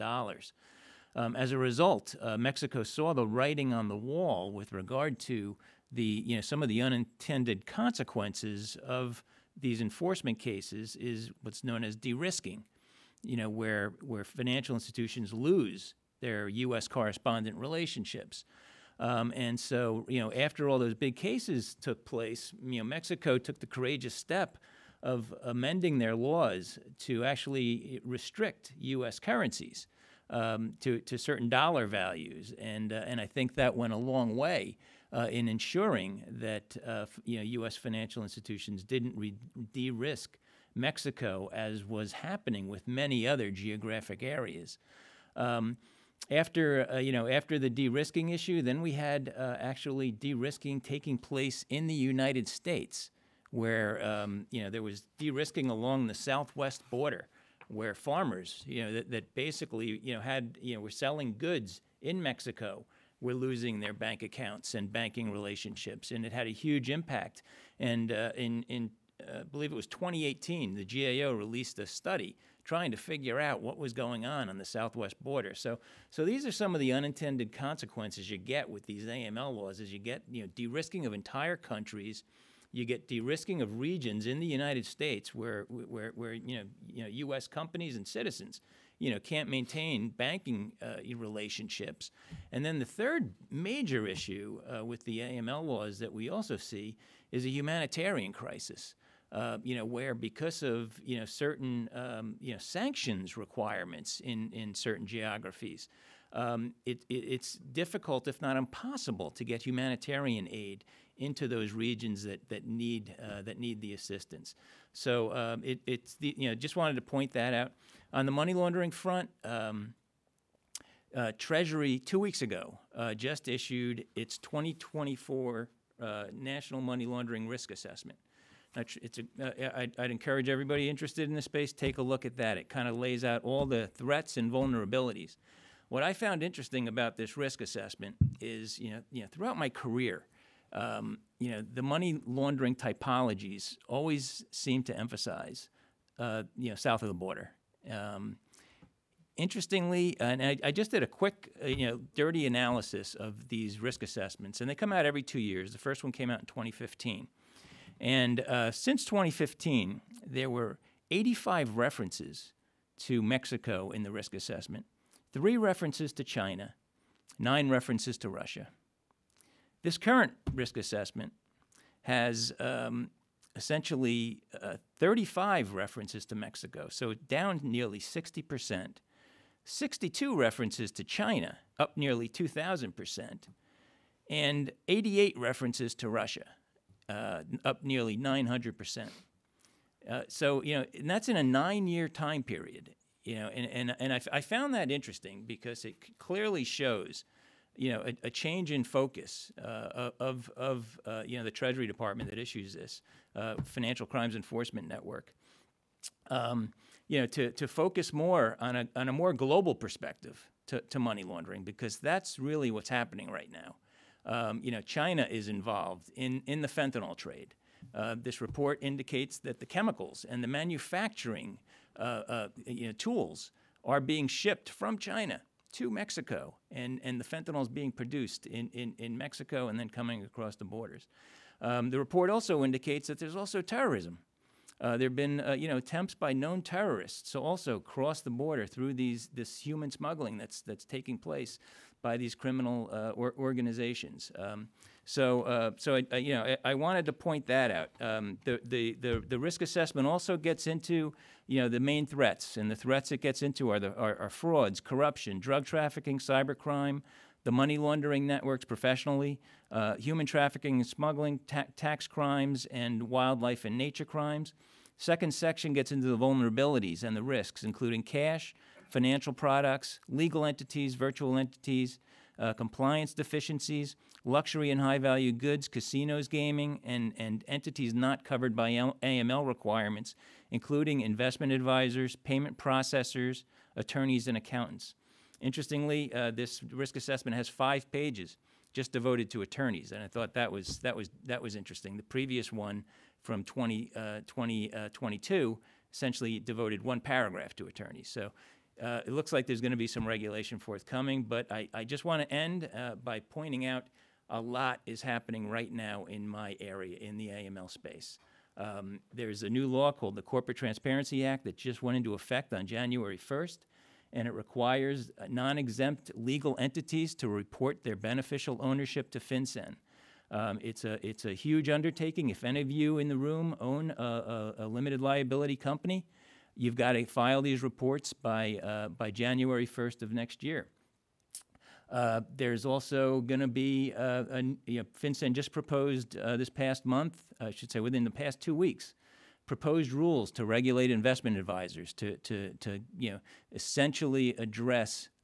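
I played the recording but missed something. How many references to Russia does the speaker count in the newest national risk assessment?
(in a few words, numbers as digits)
88.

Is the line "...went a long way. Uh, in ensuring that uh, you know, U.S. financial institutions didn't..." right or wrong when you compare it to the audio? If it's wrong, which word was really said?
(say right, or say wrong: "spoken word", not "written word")
right.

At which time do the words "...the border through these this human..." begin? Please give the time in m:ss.
3:58.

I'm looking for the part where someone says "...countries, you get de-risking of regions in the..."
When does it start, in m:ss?
1:21.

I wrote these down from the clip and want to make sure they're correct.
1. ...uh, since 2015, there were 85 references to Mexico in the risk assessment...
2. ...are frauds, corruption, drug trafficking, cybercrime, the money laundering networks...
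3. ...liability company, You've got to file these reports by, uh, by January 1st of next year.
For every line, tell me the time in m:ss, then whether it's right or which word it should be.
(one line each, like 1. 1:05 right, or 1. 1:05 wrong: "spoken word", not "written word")
1. 2:38 right
2. 4:14 right
3. 5:25 right.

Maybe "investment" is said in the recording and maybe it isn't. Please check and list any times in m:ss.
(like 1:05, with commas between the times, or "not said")
4:41, 5:40.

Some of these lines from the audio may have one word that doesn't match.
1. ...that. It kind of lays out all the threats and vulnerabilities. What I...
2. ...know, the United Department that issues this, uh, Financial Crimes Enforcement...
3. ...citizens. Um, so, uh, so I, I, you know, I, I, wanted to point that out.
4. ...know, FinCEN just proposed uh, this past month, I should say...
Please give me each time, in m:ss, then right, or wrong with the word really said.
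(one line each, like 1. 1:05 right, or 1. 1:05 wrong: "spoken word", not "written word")
1. 2:12 right
2. 3:21 wrong: "Treasury", not "United"
3. 4:03 wrong: "organizations", not "citizens"
4. 5:34 right.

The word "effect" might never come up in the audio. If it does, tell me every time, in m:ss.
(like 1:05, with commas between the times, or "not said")
5:12.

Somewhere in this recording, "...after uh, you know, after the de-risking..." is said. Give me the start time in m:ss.
0:46.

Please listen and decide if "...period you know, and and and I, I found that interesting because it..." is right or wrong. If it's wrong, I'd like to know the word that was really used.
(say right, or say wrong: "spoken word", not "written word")
right.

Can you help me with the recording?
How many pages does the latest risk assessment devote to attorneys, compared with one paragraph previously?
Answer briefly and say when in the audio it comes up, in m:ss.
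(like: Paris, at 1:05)
5, at 4:47.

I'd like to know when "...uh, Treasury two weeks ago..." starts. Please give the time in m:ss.
2:01.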